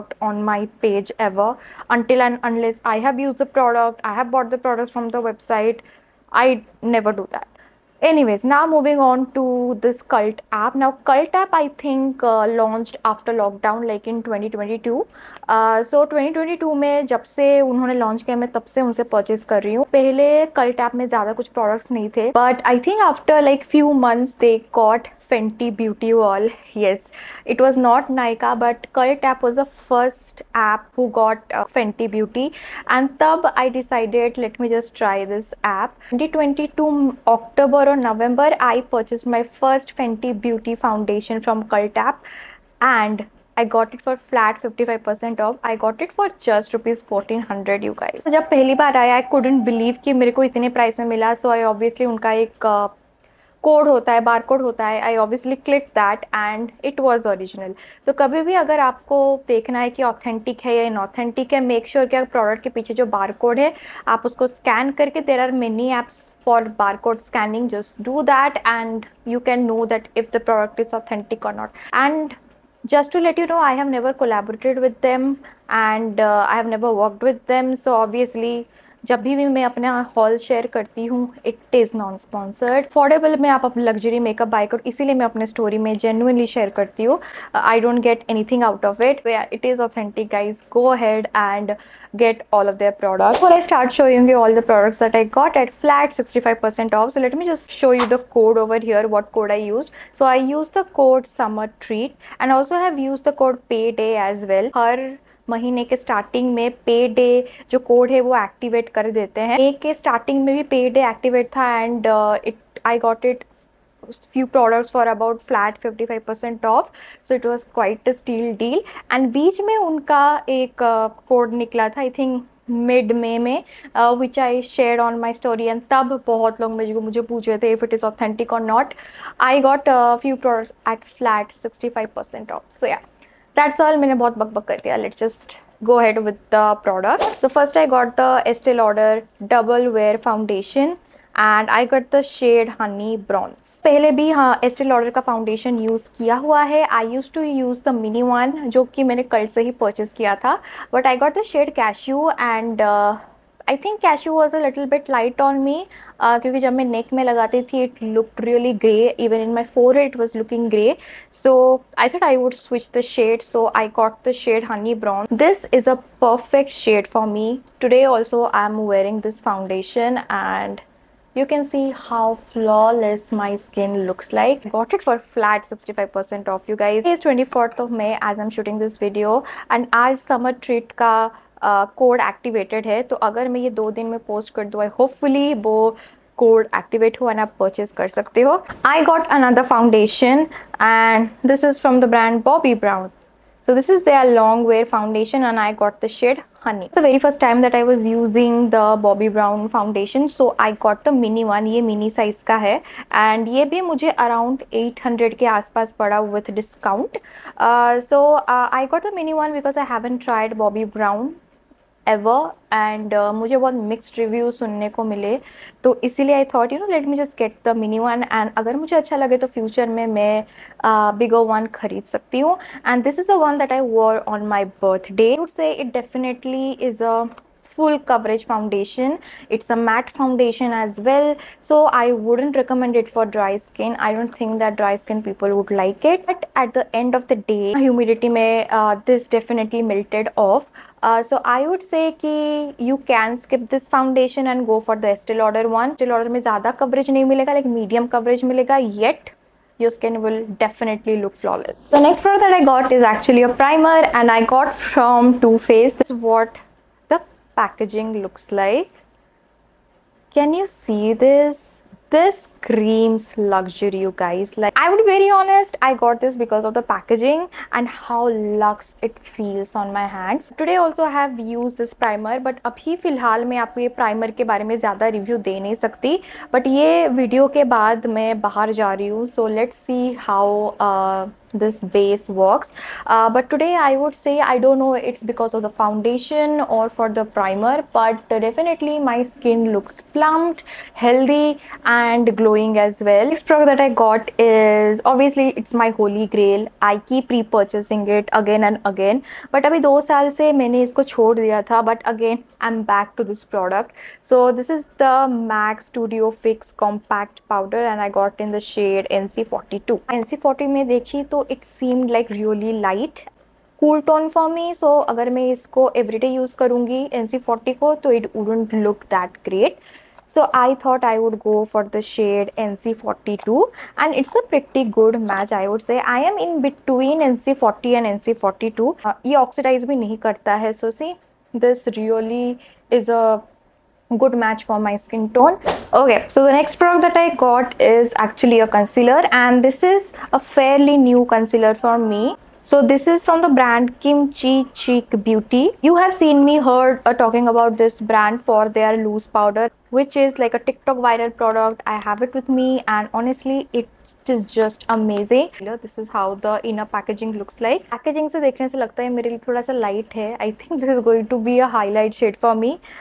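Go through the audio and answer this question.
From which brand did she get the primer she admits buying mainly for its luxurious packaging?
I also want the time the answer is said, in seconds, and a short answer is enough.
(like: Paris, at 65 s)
Too Faced, at 255 s.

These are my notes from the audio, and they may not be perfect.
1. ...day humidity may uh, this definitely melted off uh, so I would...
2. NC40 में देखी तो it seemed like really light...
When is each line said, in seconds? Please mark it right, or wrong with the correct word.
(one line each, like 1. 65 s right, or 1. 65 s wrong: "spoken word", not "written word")
1. 237 s right
2. 310 s right.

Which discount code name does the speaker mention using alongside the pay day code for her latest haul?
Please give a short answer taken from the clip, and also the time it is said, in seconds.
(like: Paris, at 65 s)
Summer Treat, at 101 s.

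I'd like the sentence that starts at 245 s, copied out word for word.
Estee Lauder में ज़्यादा coverage nahi milega, like medium coverage milega.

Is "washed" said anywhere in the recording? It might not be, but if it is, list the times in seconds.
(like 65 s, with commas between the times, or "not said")
not said.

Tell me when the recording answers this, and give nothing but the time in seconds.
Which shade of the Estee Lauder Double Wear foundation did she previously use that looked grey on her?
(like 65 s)
151 s.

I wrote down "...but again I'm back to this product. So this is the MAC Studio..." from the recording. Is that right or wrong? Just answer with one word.
right.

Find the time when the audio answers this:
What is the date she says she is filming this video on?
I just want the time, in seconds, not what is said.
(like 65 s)
177 s.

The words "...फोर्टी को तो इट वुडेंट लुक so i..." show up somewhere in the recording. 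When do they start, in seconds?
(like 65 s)
317 s.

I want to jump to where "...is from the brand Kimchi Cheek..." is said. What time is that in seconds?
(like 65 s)
343 s.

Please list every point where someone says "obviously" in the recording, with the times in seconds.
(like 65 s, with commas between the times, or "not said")
51 s, 295 s.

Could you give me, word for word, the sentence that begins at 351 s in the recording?
I have it with me and honestly it is just amazing.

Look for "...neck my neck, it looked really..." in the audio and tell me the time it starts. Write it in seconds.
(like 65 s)
156 s.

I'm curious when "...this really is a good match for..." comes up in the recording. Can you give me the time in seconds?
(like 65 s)
331 s.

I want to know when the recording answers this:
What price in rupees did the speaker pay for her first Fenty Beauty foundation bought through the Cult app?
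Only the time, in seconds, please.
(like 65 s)
46 s.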